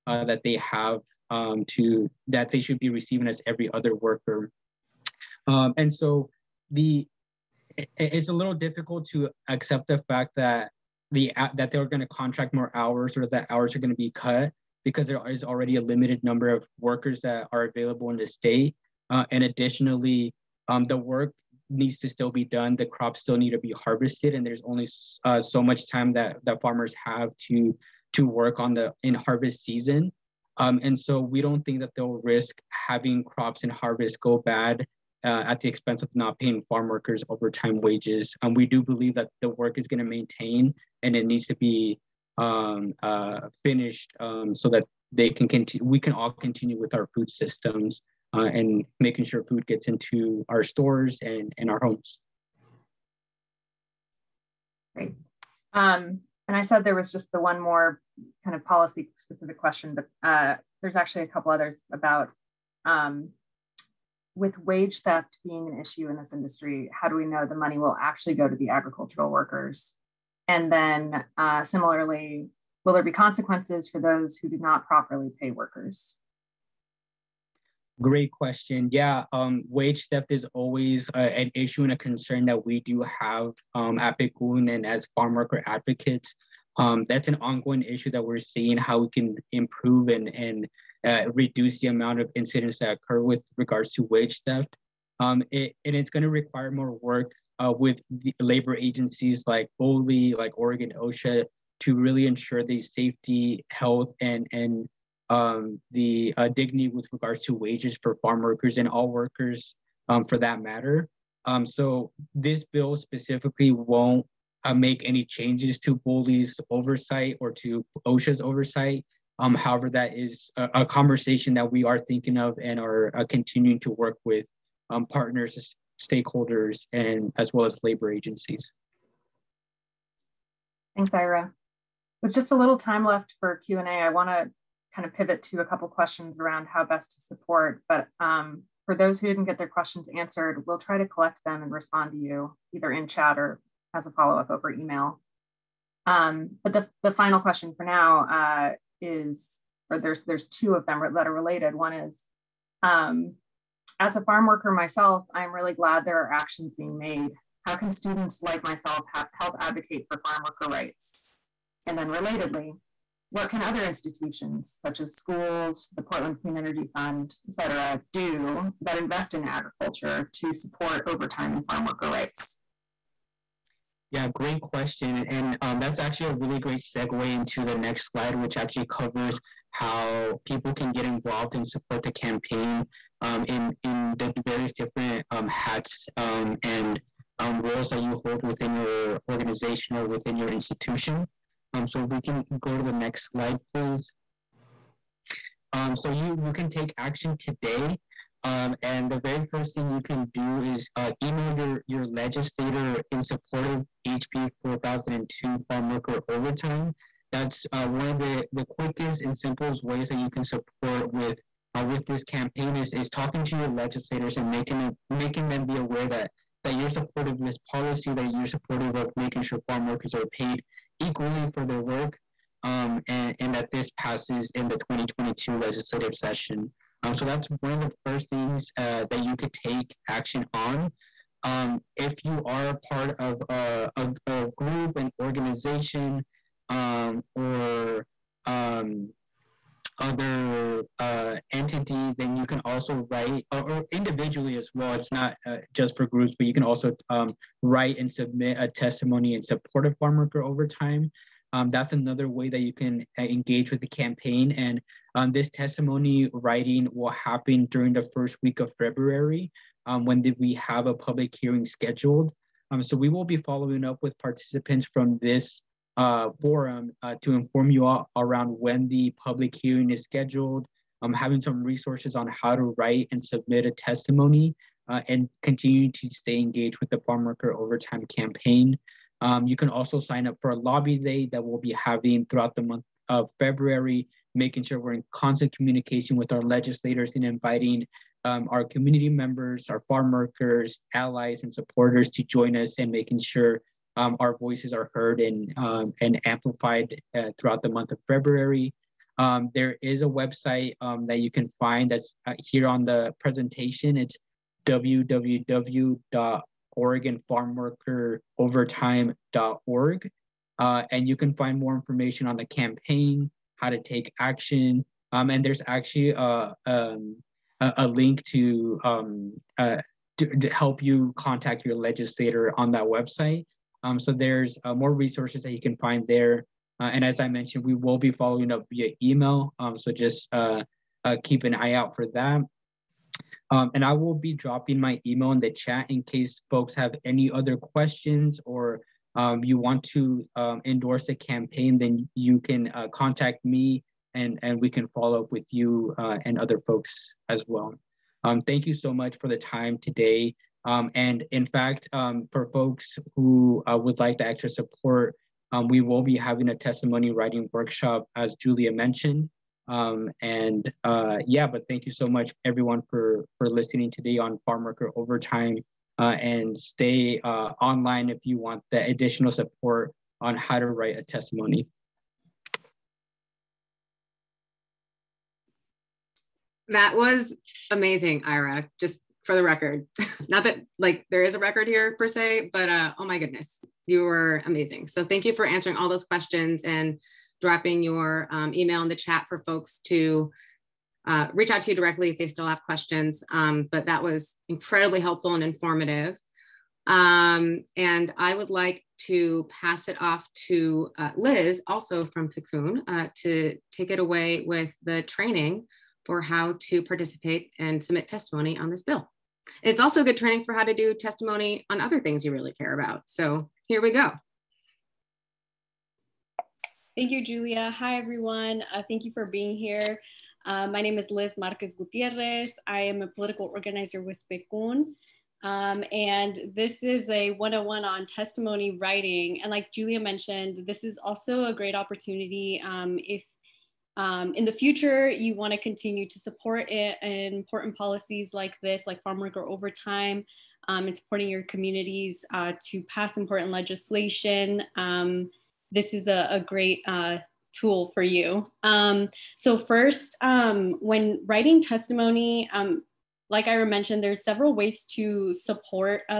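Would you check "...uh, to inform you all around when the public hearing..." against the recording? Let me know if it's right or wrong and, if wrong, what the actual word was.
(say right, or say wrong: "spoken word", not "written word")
right.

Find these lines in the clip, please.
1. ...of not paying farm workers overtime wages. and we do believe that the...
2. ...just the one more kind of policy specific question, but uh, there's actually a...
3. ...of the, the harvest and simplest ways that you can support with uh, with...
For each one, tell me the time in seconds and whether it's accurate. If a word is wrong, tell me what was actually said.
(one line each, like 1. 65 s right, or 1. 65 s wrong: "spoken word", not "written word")
1. 36 s right
2. 57 s right
3. 208 s wrong: "quickest", not "harvest".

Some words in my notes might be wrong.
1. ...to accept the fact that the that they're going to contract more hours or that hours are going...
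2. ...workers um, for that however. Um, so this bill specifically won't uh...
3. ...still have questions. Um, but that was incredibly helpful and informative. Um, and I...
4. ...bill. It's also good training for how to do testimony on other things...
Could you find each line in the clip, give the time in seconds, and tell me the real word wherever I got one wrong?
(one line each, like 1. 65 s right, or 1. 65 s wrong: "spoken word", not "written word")
1. 9 s right
2. 109 s wrong: "matter", not "however"
3. 392 s right
4. 408 s right.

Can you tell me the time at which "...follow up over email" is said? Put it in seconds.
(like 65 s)
144 s.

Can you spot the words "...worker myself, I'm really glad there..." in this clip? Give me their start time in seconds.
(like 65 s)
154 s.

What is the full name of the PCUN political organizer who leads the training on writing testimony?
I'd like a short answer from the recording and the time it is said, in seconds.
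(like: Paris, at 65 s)
Liz Marquez Gutierrez, at 421 s.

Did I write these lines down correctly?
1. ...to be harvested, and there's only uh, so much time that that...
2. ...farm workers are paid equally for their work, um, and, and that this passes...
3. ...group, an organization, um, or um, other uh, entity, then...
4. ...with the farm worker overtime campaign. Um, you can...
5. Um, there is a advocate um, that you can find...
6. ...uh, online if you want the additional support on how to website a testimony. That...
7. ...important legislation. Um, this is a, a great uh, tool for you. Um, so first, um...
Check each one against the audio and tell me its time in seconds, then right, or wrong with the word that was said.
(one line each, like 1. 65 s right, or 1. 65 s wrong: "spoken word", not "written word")
1. 23 s right
2. 219 s right
3. 234 s right
4. 276 s right
5. 299 s wrong: "website", not "advocate"
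6. 367 s wrong: "write", not "website"
7. 443 s right.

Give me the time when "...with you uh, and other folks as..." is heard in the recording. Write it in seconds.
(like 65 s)
345 s.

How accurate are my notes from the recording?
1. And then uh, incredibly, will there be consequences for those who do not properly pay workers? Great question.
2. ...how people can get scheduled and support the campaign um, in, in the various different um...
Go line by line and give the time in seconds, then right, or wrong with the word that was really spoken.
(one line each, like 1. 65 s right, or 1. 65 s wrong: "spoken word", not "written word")
1. 70 s wrong: "similarly", not "incredibly"
2. 179 s wrong: "involved", not "scheduled".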